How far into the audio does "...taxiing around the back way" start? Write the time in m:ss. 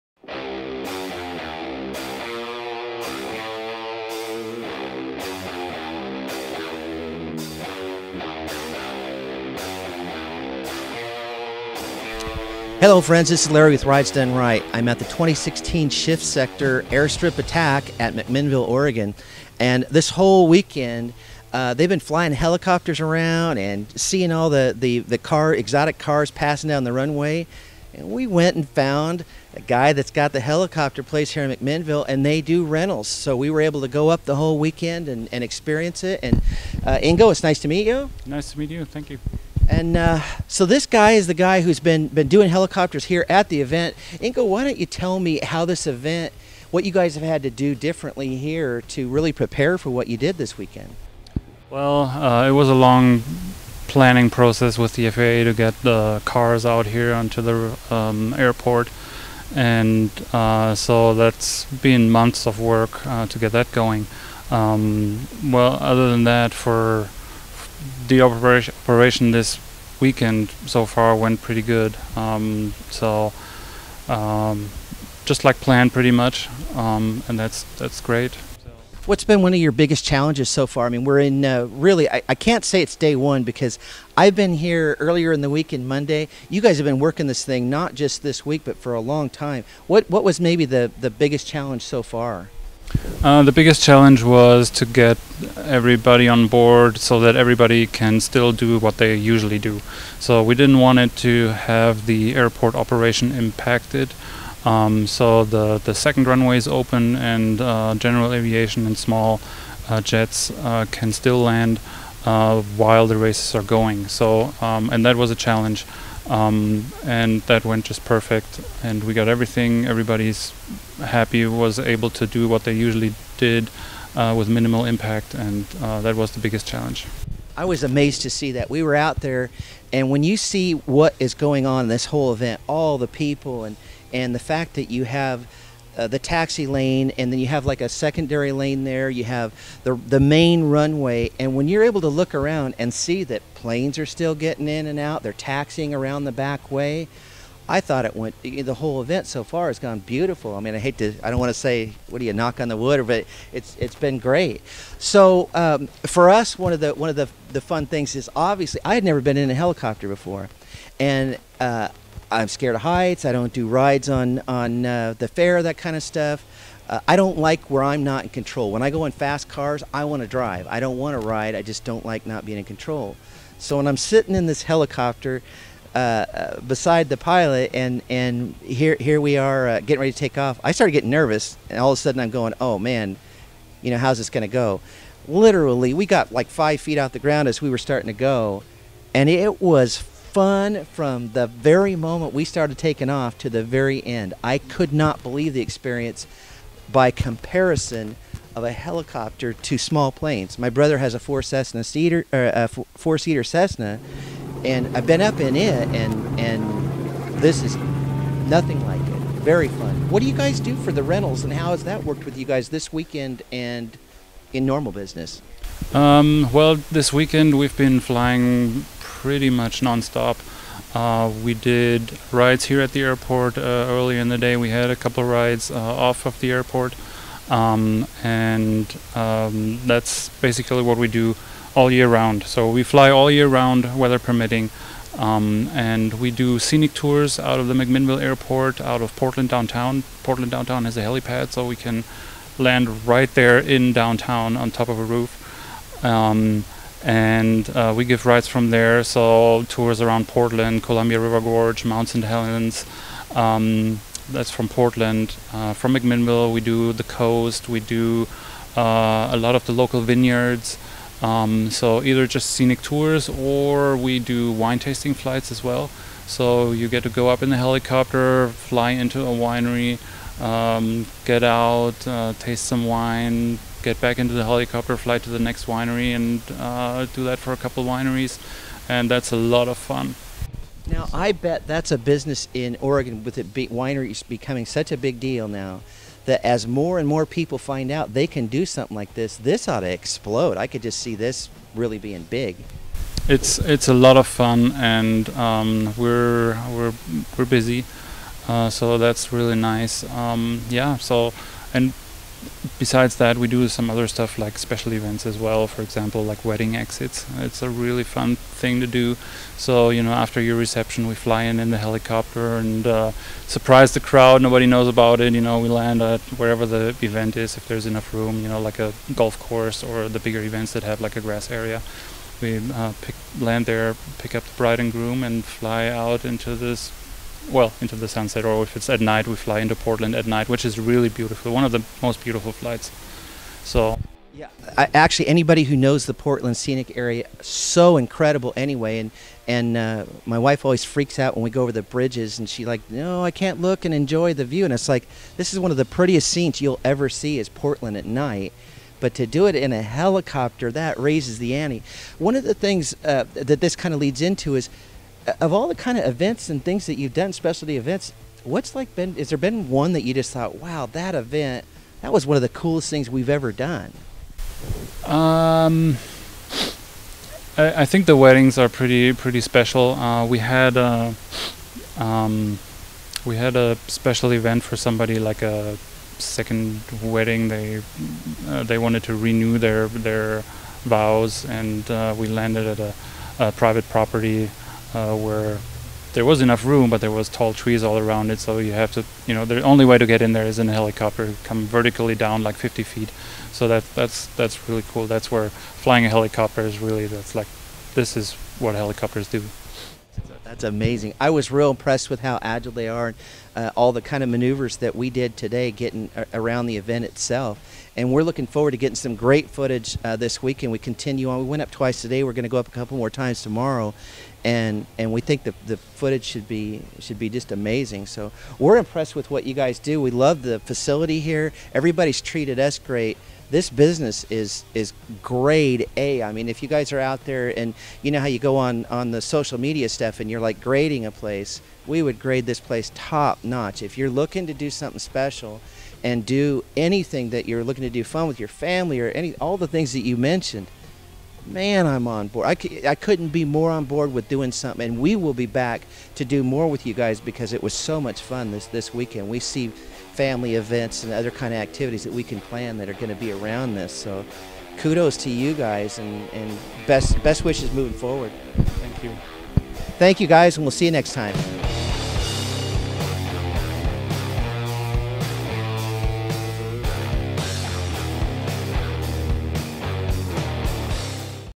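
2:25.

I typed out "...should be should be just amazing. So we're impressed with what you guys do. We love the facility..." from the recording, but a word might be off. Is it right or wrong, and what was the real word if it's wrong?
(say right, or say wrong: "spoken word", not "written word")
right.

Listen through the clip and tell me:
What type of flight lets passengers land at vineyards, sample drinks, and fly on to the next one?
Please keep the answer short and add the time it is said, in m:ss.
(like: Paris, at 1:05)
Wine tasting flights, at 4:24.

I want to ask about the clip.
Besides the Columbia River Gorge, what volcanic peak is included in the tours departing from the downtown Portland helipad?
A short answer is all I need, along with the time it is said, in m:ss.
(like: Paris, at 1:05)
Mount St. Helens, at 4:11.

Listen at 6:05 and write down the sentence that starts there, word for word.
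Um, I, I think the weddings are pretty pretty special.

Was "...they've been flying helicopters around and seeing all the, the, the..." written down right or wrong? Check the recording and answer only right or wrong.
right.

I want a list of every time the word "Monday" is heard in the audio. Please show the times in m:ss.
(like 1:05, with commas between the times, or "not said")
1:25.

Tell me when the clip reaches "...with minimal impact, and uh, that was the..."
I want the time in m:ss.
2:04.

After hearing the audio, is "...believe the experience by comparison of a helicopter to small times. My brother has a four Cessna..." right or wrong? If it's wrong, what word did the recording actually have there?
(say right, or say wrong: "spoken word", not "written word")
wrong: "planes", not "times".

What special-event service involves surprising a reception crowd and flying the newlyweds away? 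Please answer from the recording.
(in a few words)
Wedding exits.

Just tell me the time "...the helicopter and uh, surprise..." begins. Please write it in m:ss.
5:11.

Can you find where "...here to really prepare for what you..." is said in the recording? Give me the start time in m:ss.
0:48.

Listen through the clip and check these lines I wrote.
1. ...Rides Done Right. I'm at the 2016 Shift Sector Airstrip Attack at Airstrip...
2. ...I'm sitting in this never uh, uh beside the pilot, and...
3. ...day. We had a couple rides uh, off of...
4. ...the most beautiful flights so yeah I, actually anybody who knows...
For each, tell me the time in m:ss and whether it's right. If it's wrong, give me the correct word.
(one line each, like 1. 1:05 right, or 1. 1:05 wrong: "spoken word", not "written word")
1. 0:13 wrong: "McMinnville", not "Airstrip"
2. 2:53 wrong: "helicopter", not "never"
3. 3:44 right
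4. 5:31 right.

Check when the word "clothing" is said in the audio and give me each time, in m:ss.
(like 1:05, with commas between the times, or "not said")
not said.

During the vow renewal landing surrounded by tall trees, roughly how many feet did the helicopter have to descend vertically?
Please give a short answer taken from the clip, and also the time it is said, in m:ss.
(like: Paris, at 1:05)
50 feet, at 6:32.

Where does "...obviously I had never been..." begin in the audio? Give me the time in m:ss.
2:38.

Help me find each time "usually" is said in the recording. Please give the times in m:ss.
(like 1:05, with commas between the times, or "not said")
1:39, 2:02.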